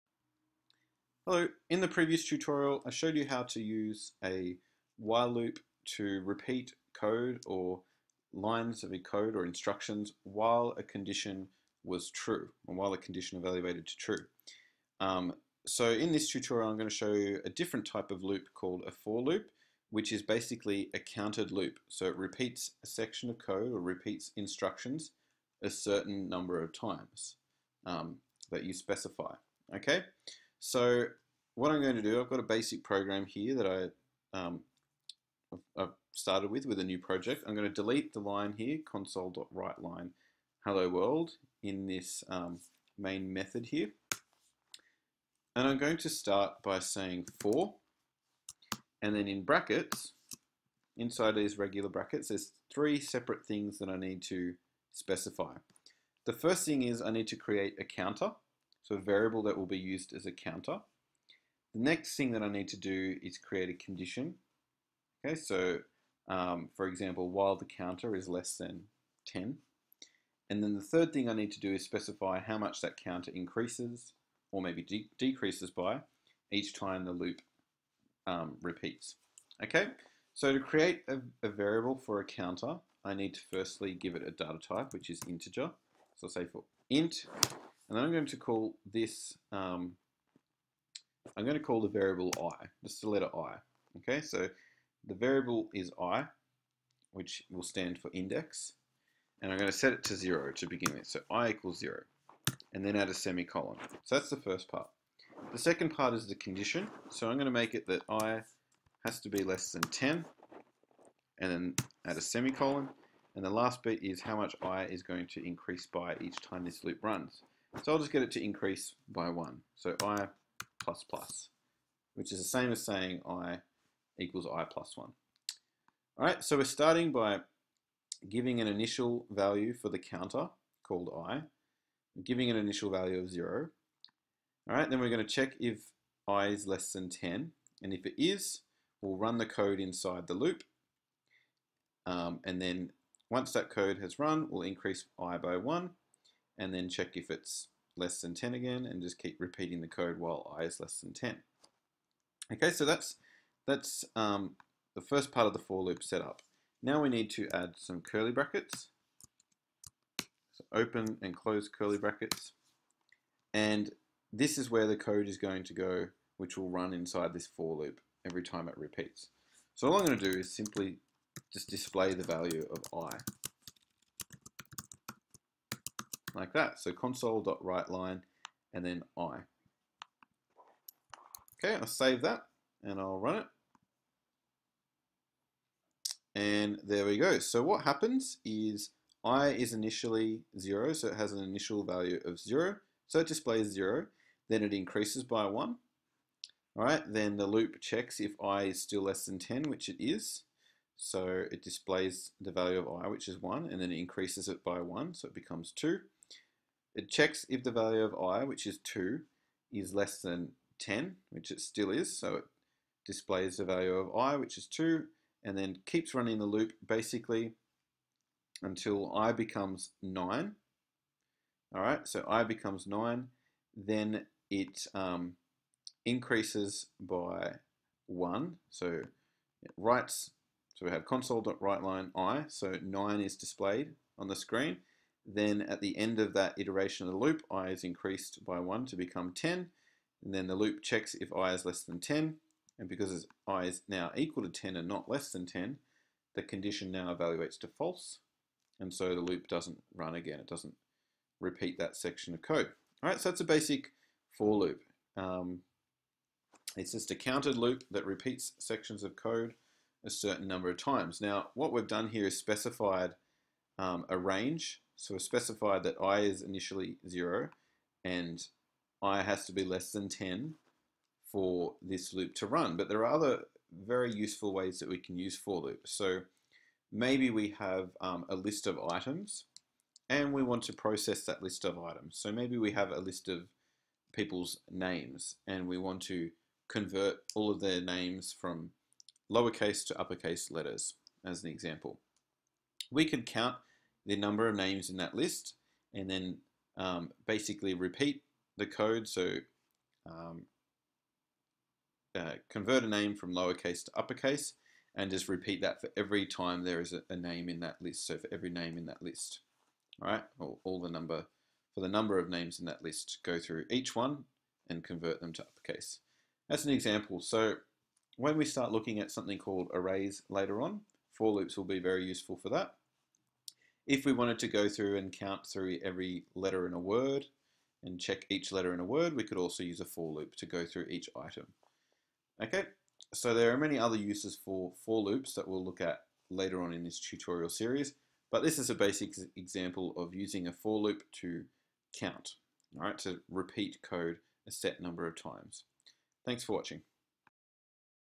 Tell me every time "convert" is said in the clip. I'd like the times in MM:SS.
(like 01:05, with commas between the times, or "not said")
04:46, 05:02, 05:14.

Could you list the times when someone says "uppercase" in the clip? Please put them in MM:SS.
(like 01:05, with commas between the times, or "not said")
04:49, 05:03, 05:15.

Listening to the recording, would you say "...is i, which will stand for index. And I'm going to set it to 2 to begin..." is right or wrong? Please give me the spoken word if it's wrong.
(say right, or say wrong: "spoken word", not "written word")
wrong: "0", not "2".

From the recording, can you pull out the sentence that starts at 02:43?
And this is where the code is going to go, which will run inside this for loop every time it repeats.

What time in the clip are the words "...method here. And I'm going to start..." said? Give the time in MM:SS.
00:43.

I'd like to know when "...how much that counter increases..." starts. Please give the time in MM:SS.
01:12.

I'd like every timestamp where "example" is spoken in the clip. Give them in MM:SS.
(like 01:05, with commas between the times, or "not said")
01:06, 04:51, 05:16, 05:39.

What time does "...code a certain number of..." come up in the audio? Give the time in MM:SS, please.
04:19.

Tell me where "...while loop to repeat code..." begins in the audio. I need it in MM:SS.
00:04.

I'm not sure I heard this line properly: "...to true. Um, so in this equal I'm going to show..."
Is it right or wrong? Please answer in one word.
wrong.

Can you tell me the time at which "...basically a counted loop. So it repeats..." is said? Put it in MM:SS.
00:20.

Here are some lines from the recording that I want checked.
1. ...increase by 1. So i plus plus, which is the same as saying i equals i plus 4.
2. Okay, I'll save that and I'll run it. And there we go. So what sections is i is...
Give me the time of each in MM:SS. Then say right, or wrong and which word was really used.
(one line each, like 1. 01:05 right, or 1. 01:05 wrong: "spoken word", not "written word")
1. 01:58 wrong: "1", not "4"
2. 03:01 wrong: "happens", not "sections".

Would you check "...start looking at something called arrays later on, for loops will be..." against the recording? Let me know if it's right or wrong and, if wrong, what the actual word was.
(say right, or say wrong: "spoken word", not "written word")
right.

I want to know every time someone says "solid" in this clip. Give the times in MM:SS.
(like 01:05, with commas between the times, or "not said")
not said.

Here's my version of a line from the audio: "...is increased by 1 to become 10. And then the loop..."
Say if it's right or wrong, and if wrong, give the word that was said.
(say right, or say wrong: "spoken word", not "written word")
right.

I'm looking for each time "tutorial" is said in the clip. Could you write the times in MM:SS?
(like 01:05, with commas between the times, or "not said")
00:02, 00:16, 05:36.